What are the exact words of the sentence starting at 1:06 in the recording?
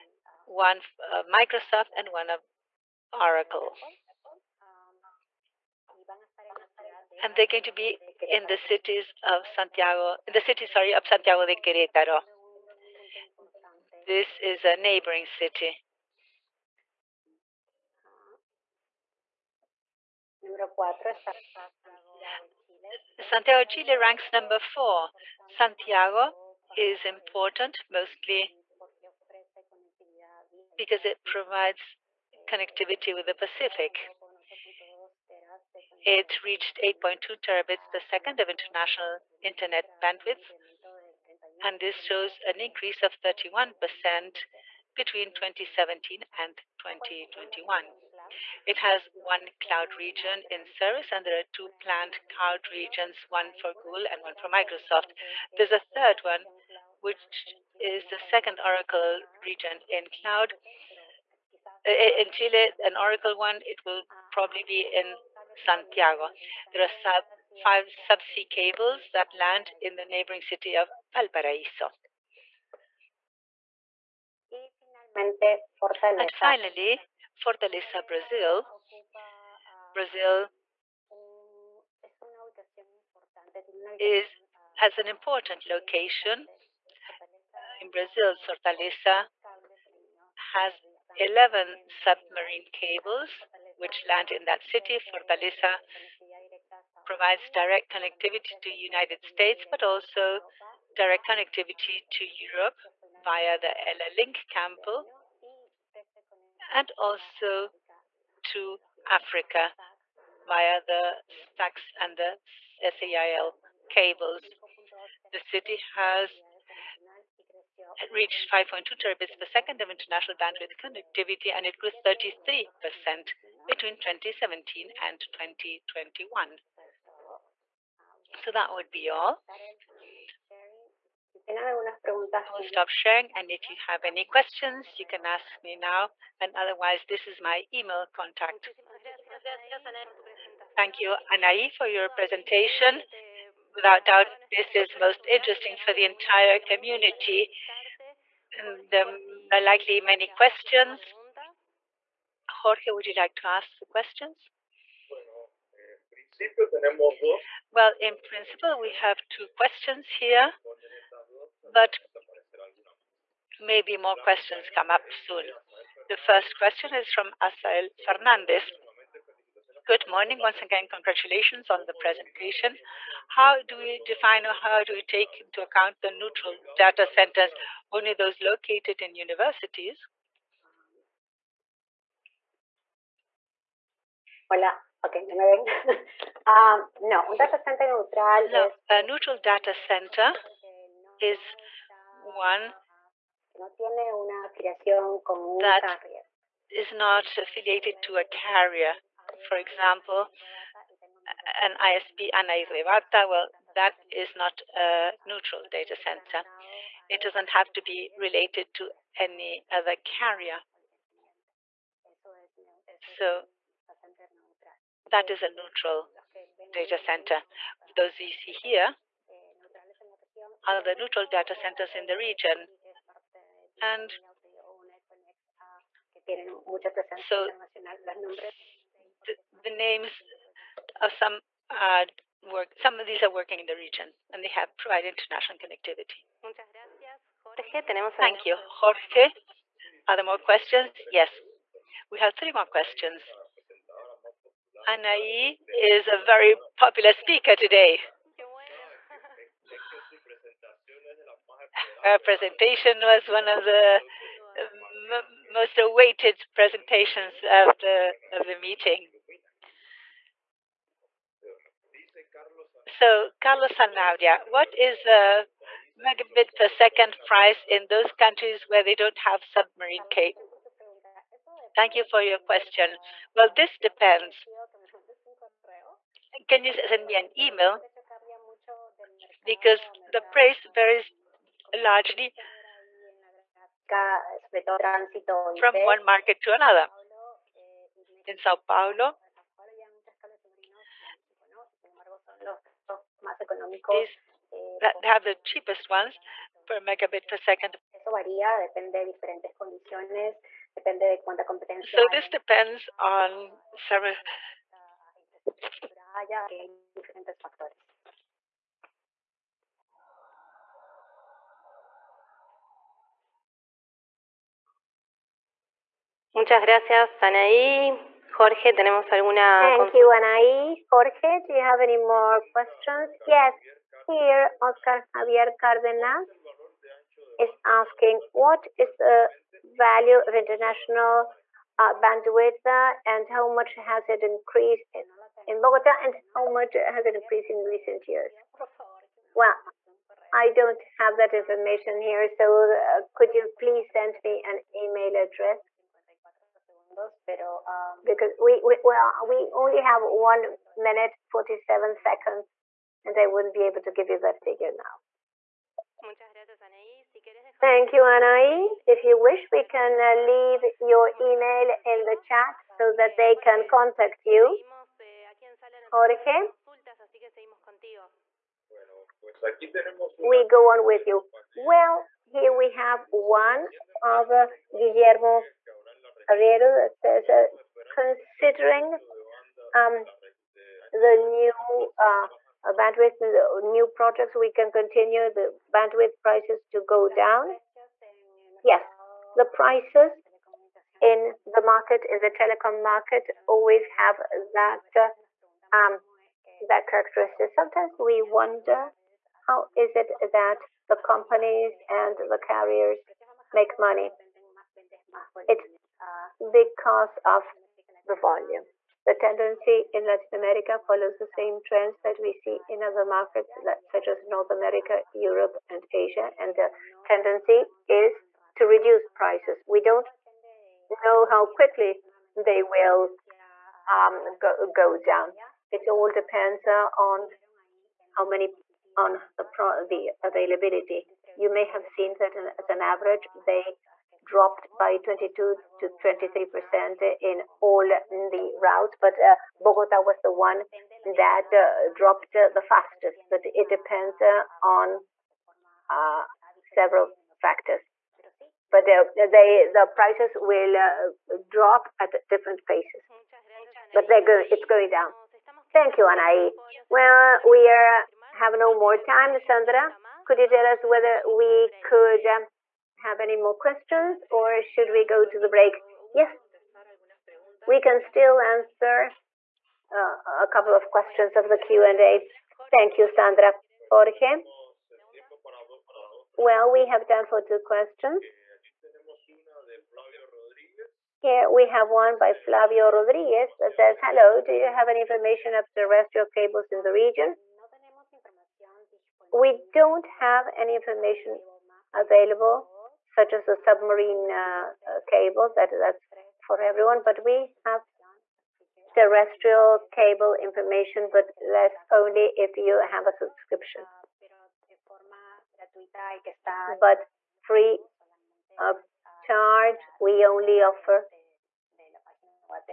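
There are sub five subsea cables that land in the neighboring city of Valparaíso.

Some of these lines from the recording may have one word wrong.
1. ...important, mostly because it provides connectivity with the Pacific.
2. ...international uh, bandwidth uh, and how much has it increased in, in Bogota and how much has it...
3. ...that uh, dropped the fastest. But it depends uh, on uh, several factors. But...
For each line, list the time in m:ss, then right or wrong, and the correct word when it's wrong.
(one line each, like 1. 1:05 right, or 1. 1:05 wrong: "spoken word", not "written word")
1. 0:27 right
2. 5:30 right
3. 7:21 right.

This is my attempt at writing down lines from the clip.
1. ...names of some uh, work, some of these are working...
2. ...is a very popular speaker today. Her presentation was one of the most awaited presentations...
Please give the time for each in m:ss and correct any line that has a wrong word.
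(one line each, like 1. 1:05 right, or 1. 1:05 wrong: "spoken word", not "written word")
1. 3:49 right
2. 4:05 right.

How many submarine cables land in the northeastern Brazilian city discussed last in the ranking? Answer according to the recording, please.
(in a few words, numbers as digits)
11.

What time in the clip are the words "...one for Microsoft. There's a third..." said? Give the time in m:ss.
0:54.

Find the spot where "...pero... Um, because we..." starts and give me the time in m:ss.
5:47.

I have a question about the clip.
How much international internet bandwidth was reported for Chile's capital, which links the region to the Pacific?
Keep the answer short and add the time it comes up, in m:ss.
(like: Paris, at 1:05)
8.2 terabits per second, at 0:36.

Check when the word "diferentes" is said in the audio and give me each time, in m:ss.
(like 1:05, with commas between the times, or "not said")
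4:59, 5:06.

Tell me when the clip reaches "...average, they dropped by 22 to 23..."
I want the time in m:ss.
7:12.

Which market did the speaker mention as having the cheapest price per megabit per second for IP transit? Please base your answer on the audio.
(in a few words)
Sao Paulo.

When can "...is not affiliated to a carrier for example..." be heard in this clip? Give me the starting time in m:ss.
3:16.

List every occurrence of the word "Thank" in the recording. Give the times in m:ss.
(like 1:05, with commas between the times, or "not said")
2:20, 3:58, 4:31, 5:19, 5:57, 7:35, 7:52.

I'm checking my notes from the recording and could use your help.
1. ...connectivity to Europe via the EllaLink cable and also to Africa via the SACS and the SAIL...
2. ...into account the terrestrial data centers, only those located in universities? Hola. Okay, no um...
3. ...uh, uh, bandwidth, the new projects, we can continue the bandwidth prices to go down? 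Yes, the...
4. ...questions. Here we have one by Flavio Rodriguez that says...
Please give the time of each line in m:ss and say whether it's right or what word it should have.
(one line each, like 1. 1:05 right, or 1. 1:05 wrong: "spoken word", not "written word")
1. 1:41 right
2. 2:55 wrong: "neutral", not "terrestrial"
3. 6:21 right
4. 7:57 right.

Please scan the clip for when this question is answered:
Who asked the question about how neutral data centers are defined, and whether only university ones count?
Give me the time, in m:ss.
2:47.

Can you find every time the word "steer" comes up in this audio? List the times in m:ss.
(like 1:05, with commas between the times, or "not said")
not said.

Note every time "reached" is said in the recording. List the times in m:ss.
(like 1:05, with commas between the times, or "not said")
0:36, 1:58.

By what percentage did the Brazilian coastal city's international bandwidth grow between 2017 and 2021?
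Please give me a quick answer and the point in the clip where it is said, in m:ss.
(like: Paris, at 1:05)
33%, at 2:01.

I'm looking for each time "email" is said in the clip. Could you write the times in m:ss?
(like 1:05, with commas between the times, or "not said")
2:17, 4:37, 5:44, 6:01.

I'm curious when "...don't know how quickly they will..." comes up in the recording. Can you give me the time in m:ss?
6:59.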